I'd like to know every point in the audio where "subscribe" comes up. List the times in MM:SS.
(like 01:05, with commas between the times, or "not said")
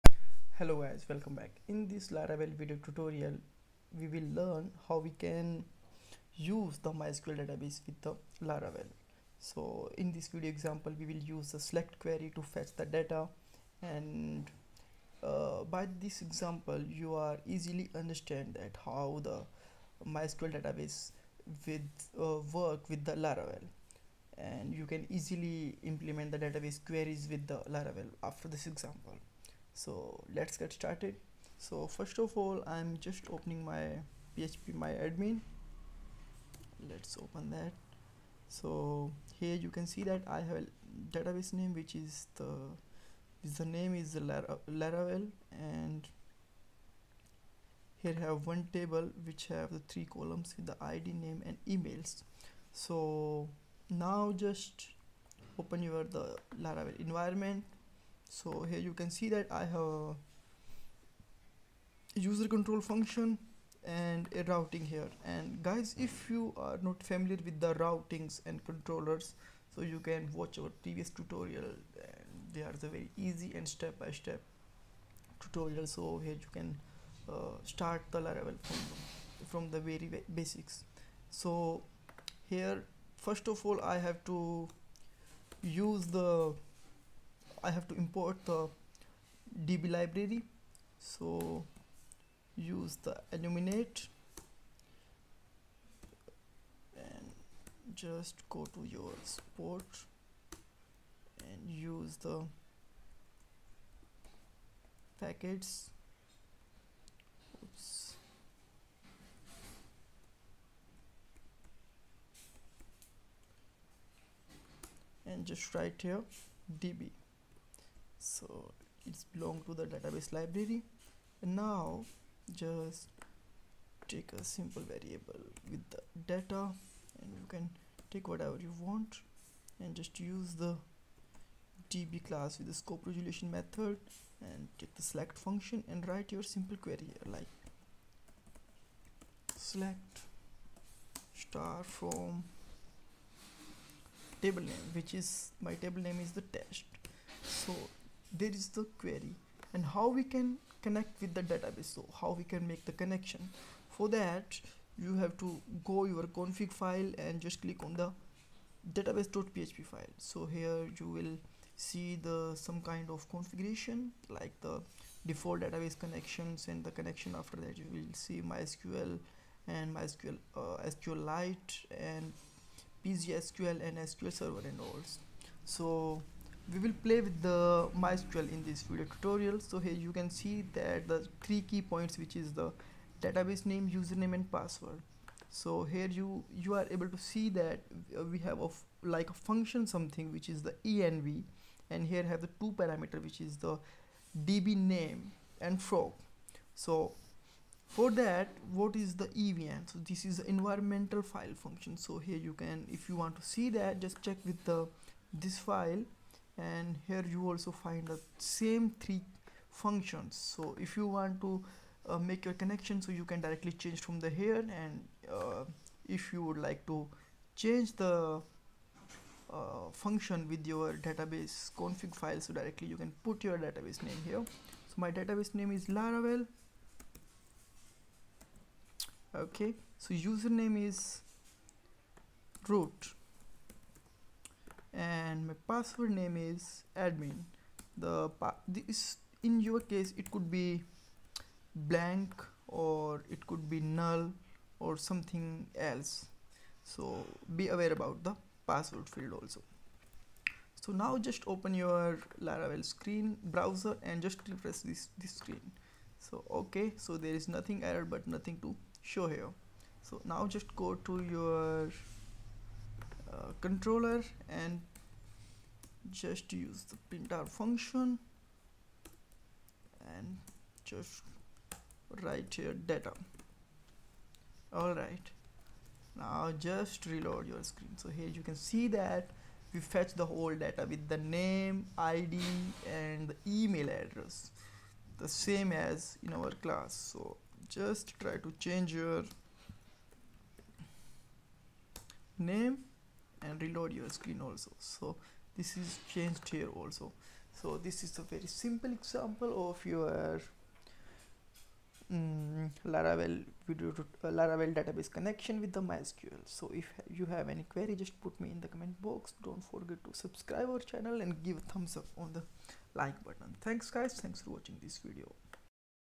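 05:10.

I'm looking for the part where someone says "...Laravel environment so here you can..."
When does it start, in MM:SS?
00:56.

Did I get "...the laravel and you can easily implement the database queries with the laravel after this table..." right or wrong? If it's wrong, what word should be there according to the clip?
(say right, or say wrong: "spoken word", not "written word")
wrong: "example", not "table".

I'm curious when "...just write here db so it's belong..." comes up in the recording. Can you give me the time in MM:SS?
01:55.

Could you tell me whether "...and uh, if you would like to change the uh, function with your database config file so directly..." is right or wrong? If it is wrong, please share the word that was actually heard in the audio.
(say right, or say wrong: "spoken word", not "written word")
right.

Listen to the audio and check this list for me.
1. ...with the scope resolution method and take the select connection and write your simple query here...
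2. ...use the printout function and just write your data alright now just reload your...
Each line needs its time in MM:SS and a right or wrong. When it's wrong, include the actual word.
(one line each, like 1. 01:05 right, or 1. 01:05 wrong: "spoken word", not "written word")
1. 02:12 wrong: "function", not "connection"
2. 04:26 right.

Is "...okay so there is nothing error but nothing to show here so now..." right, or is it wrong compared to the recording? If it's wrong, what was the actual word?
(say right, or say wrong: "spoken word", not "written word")
right.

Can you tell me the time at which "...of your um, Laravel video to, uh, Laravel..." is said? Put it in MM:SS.
04:59.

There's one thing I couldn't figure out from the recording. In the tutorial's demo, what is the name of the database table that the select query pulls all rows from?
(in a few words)
test.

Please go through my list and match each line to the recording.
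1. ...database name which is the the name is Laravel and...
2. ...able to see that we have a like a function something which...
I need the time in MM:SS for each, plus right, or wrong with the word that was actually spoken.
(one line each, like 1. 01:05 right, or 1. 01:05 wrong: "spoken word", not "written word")
1. 00:41 right
2. 03:06 right.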